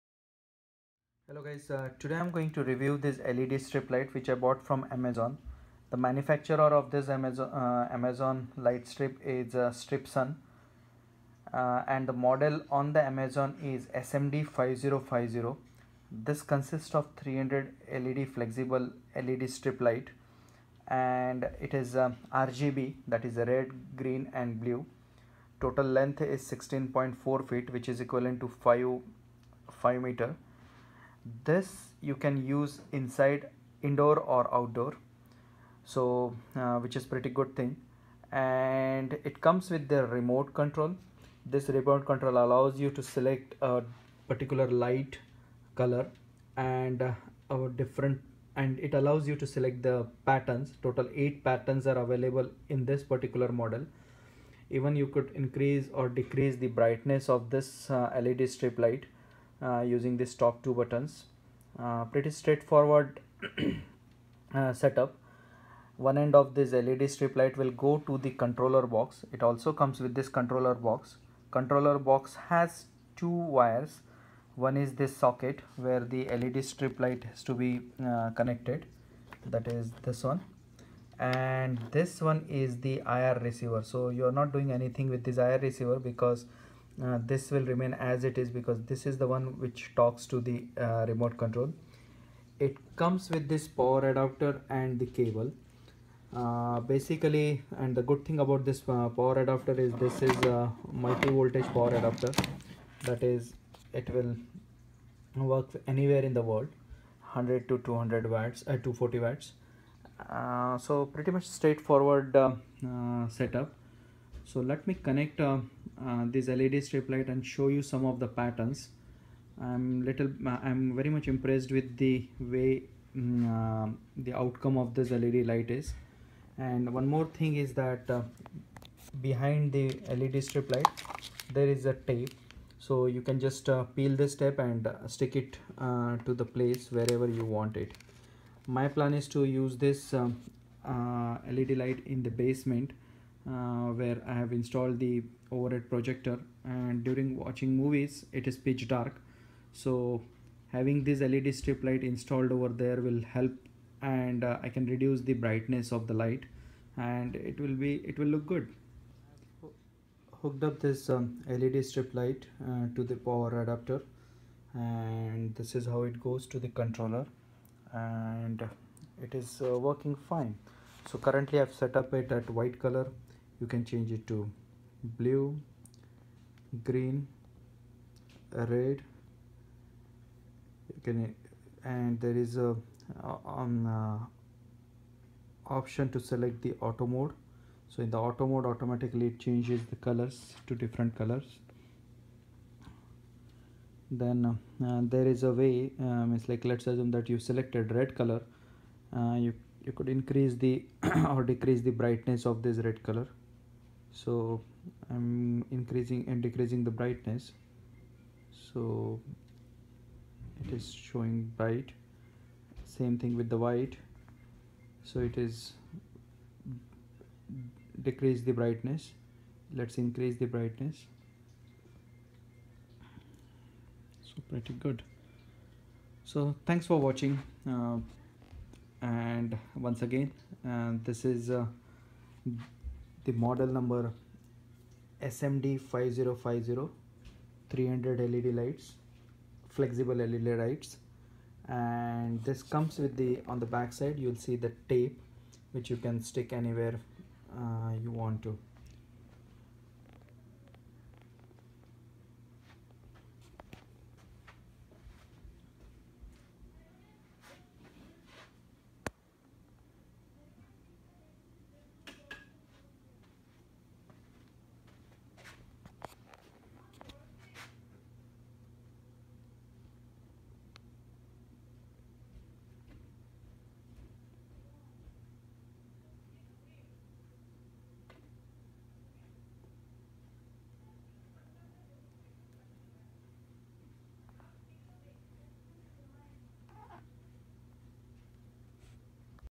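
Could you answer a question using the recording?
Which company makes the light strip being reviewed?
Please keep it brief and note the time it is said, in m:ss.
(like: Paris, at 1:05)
Strip Sun, at 0:09.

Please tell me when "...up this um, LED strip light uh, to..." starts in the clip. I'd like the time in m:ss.
2:40.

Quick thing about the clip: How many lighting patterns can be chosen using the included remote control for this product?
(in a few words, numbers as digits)
8.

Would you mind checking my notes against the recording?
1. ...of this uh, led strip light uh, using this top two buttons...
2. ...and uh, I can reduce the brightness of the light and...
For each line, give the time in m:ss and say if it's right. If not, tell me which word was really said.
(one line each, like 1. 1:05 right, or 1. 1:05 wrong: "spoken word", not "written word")
1. 0:57 right
2. 2:34 right.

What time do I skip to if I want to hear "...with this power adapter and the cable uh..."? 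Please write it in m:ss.
1:33.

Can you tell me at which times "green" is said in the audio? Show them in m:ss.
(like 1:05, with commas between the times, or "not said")
0:24, 2:56.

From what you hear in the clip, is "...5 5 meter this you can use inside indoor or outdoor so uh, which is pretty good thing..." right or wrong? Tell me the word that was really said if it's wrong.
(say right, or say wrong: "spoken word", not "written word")
right.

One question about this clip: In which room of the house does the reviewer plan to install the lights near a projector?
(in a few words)
basement.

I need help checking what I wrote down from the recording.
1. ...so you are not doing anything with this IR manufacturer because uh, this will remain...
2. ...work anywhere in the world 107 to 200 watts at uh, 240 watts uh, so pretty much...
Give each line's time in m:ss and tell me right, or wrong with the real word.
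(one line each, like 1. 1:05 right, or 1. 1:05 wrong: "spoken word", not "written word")
1. 1:23 wrong: "receiver", not "manufacturer"
2. 1:45 wrong: "100", not "107".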